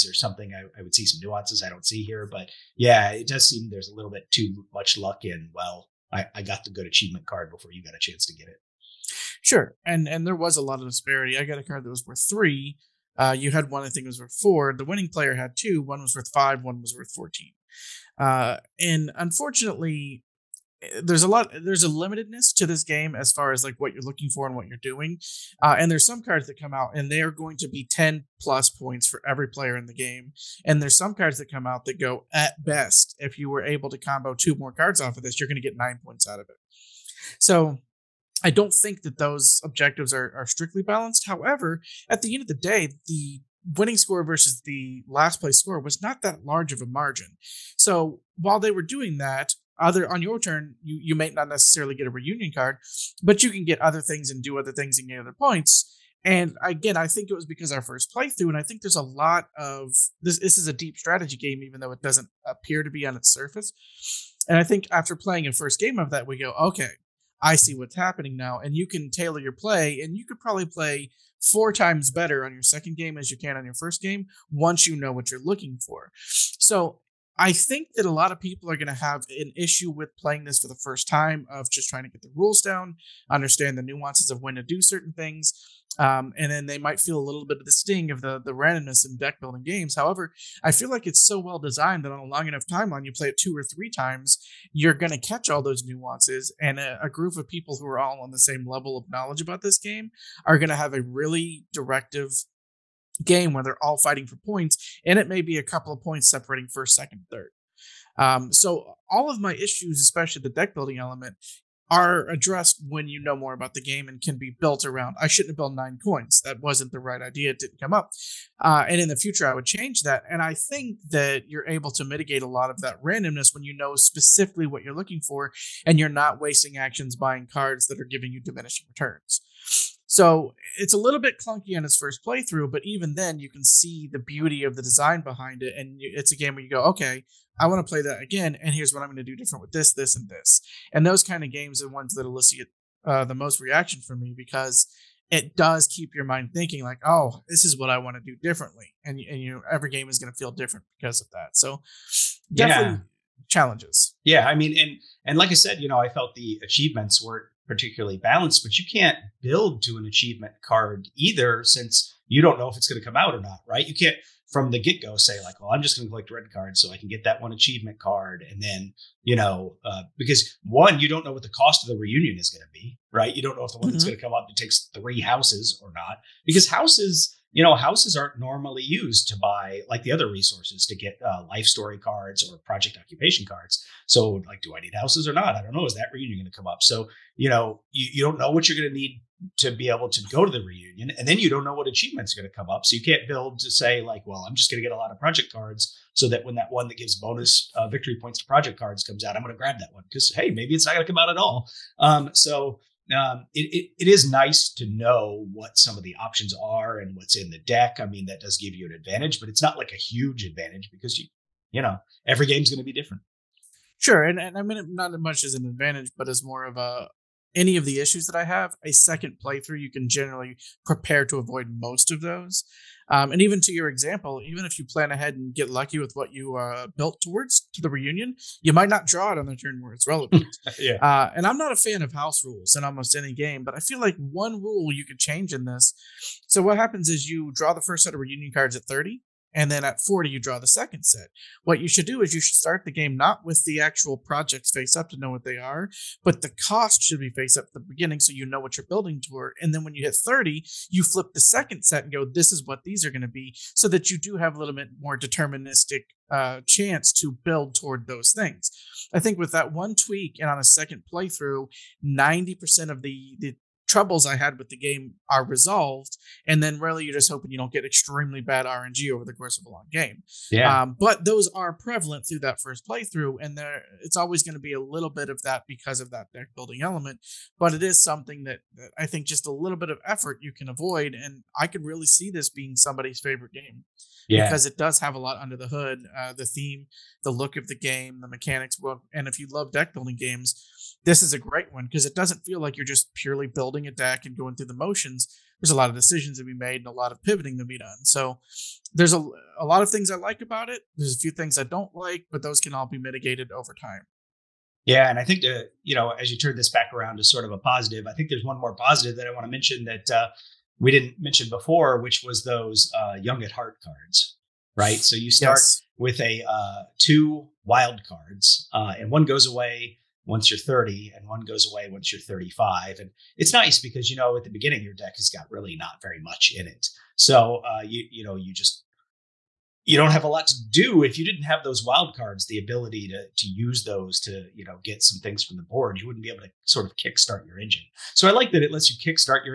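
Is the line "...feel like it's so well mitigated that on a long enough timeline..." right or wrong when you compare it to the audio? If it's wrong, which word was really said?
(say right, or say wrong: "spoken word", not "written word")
wrong: "designed", not "mitigated".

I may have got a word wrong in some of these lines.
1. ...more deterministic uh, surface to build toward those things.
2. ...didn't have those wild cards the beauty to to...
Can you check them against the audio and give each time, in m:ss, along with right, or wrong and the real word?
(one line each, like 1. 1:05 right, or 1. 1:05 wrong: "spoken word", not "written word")
1. 4:14 wrong: "chance", not "surface"
2. 5:31 wrong: "ability", not "beauty".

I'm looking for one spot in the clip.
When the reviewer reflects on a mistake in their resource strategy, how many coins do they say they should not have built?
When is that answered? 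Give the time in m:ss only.
1:55.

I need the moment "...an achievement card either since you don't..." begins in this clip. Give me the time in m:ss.
2:39.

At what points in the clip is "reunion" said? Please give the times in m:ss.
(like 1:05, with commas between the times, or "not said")
0:52, 2:51, 3:06, 3:10, 3:47, 3:58.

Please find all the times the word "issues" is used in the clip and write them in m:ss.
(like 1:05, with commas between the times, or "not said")
1:19, 1:49, 3:37.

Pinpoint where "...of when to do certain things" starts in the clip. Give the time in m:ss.
1:24.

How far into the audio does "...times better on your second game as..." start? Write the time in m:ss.
1:11.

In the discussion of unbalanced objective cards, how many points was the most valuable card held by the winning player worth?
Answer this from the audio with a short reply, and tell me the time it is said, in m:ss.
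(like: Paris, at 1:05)
14, at 0:17.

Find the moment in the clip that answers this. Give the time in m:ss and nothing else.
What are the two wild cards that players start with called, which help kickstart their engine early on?
5:13.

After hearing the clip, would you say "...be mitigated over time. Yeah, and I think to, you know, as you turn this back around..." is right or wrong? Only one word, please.
right.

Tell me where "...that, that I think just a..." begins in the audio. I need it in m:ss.
4:38.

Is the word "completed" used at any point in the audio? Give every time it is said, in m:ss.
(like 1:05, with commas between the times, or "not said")
not said.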